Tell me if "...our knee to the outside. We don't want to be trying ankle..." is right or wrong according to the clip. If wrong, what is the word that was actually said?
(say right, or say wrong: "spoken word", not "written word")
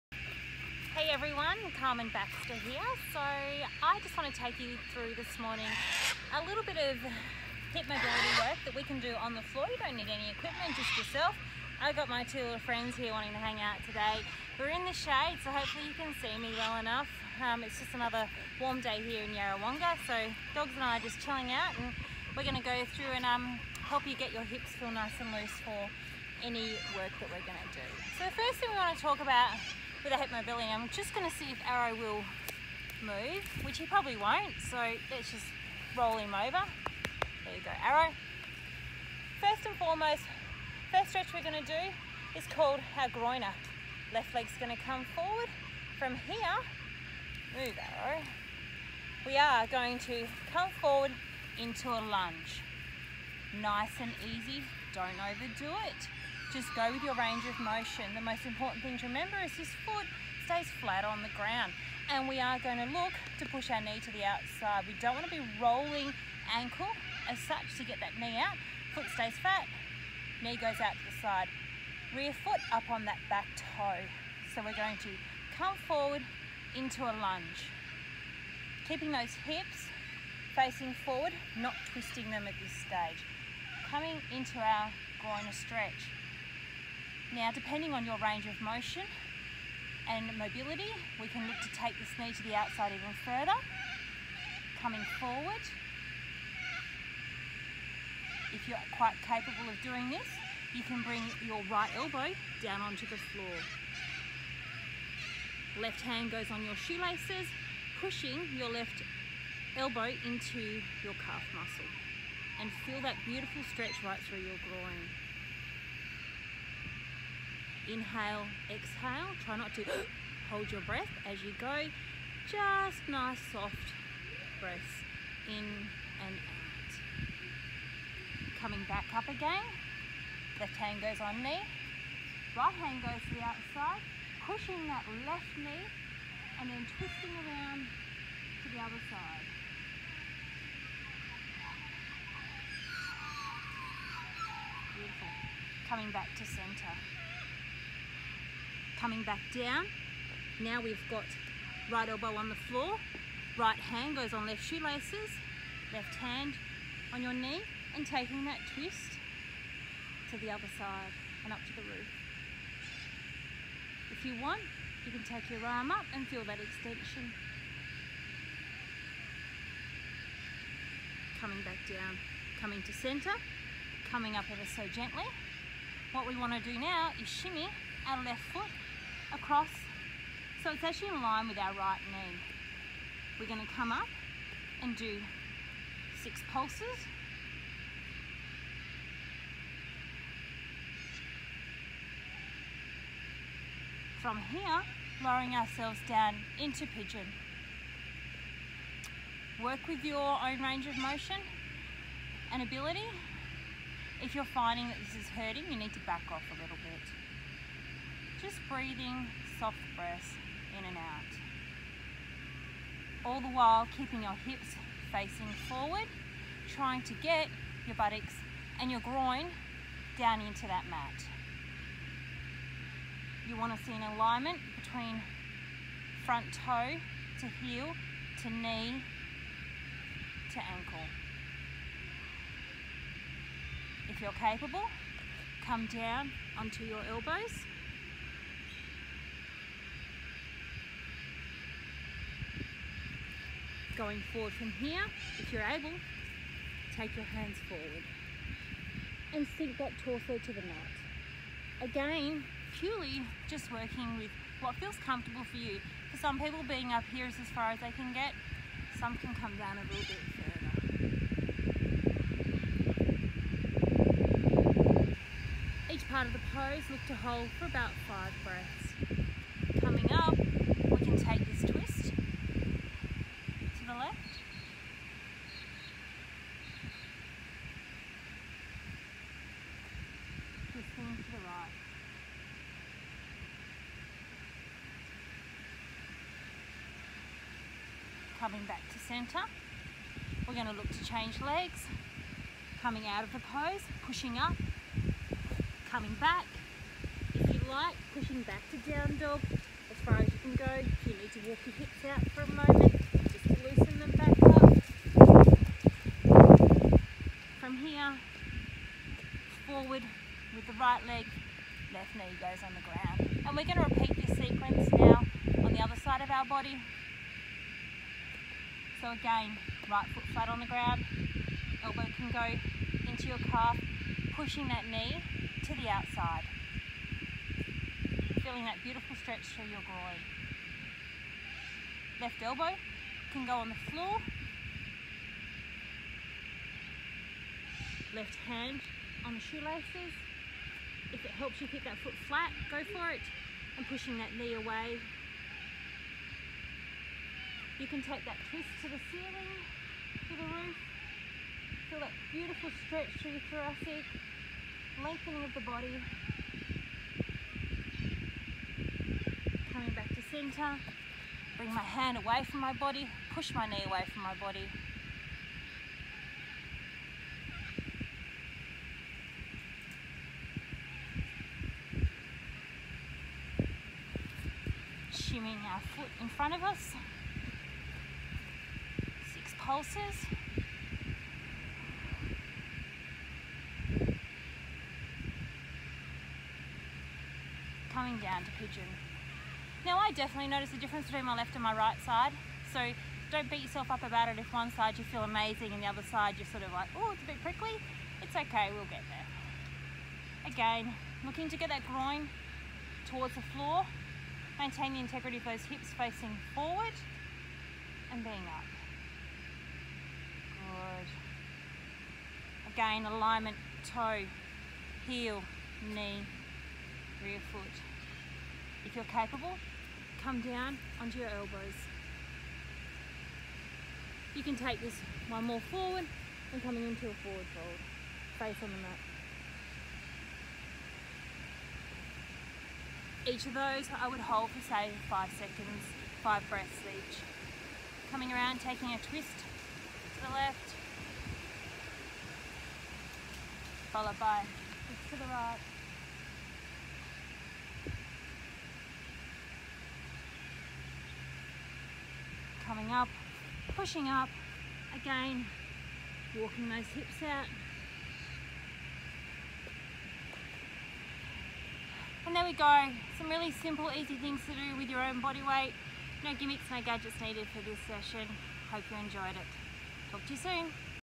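wrong: "rolling", not "trying".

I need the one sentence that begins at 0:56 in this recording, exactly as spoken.
Just go with your range of motion.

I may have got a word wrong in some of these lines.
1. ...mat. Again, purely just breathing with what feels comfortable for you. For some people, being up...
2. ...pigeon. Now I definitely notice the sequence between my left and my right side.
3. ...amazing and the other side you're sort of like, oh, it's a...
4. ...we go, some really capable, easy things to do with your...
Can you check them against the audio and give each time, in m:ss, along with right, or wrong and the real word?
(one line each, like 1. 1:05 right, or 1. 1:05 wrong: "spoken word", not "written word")
1. 4:10 wrong: "working", not "breathing"
2. 6:28 wrong: "difference", not "sequence"
3. 6:35 right
4. 7:42 wrong: "simple", not "capable".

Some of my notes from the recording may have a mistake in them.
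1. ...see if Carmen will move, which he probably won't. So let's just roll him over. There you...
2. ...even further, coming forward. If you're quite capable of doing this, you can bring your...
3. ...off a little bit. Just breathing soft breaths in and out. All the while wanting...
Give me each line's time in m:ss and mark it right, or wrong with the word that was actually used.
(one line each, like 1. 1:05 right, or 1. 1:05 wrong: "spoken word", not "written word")
1. 0:31 wrong: "Arrow", not "Carmen"
2. 1:32 right
3. 3:26 wrong: "keeping", not "wanting".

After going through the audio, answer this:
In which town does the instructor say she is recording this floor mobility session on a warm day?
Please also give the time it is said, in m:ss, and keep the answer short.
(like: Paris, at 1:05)
Yarrawonga, at 0:19.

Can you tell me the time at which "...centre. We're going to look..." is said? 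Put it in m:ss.
4:48.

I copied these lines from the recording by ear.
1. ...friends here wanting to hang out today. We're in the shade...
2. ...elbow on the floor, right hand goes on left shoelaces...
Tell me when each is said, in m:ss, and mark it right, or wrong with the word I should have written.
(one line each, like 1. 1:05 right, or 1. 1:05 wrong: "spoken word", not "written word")
1. 0:12 right
2. 2:32 right.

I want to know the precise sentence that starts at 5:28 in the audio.
Feeling that beautiful stretch through your groin.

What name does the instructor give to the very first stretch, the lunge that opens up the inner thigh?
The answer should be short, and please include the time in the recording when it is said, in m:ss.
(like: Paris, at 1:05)
groiner, at 0:43.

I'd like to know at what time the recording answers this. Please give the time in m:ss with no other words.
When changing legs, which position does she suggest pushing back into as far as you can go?
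4:58.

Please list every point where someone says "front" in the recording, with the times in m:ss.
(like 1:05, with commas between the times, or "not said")
3:46, 6:16.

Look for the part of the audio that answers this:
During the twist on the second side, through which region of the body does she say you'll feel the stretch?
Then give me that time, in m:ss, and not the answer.
5:53.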